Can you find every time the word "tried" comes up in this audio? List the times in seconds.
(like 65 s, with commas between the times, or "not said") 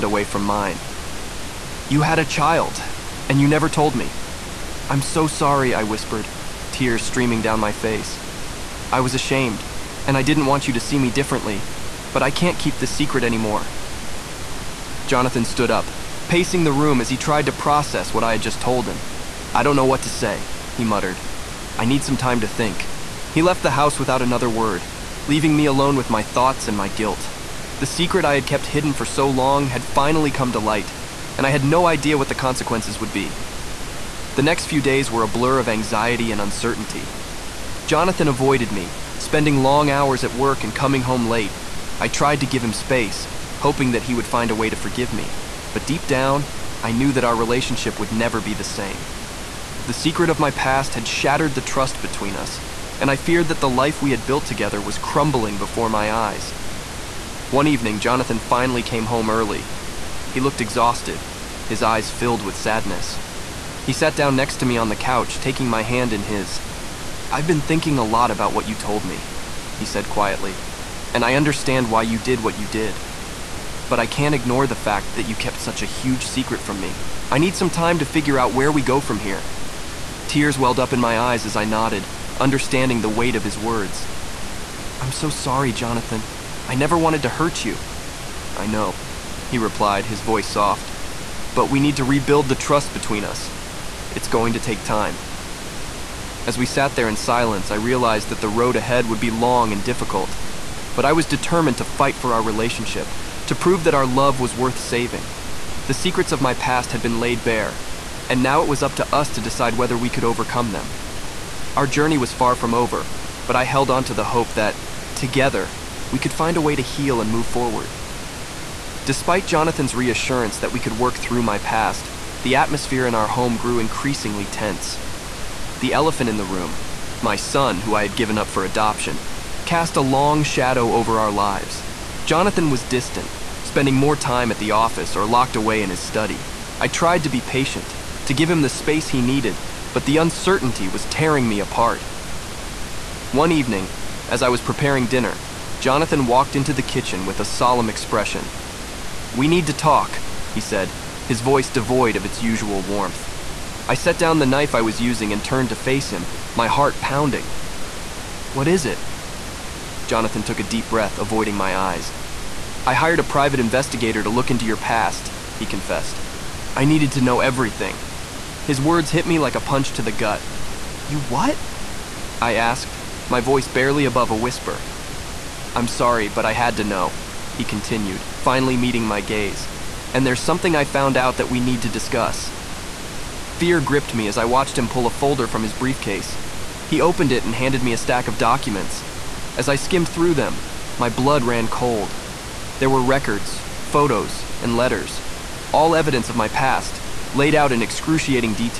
17 s, 42 s, 136 s.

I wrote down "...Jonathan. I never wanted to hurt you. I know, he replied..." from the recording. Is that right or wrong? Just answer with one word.
right.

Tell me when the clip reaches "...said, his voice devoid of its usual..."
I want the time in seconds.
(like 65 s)
150 s.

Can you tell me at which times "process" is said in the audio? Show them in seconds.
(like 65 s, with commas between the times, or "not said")
17 s.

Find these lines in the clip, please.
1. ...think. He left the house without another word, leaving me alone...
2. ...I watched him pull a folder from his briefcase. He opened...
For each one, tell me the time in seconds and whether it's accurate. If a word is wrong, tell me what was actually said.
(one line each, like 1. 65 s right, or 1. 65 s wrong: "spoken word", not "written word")
1. 22 s right
2. 184 s right.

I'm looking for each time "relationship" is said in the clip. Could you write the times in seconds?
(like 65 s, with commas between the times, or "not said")
47 s, 102 s.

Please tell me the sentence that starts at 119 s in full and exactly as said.
Despite Jonathan's reassurance that we could work through my past, the atmosphere in our home grew increasingly tense.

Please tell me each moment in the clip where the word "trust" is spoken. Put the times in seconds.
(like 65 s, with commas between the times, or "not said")
51 s, 92 s.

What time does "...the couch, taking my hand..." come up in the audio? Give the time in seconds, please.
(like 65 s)
64 s.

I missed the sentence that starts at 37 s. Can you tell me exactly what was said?
Jonathan avoided me, spending long hours at work and coming home late.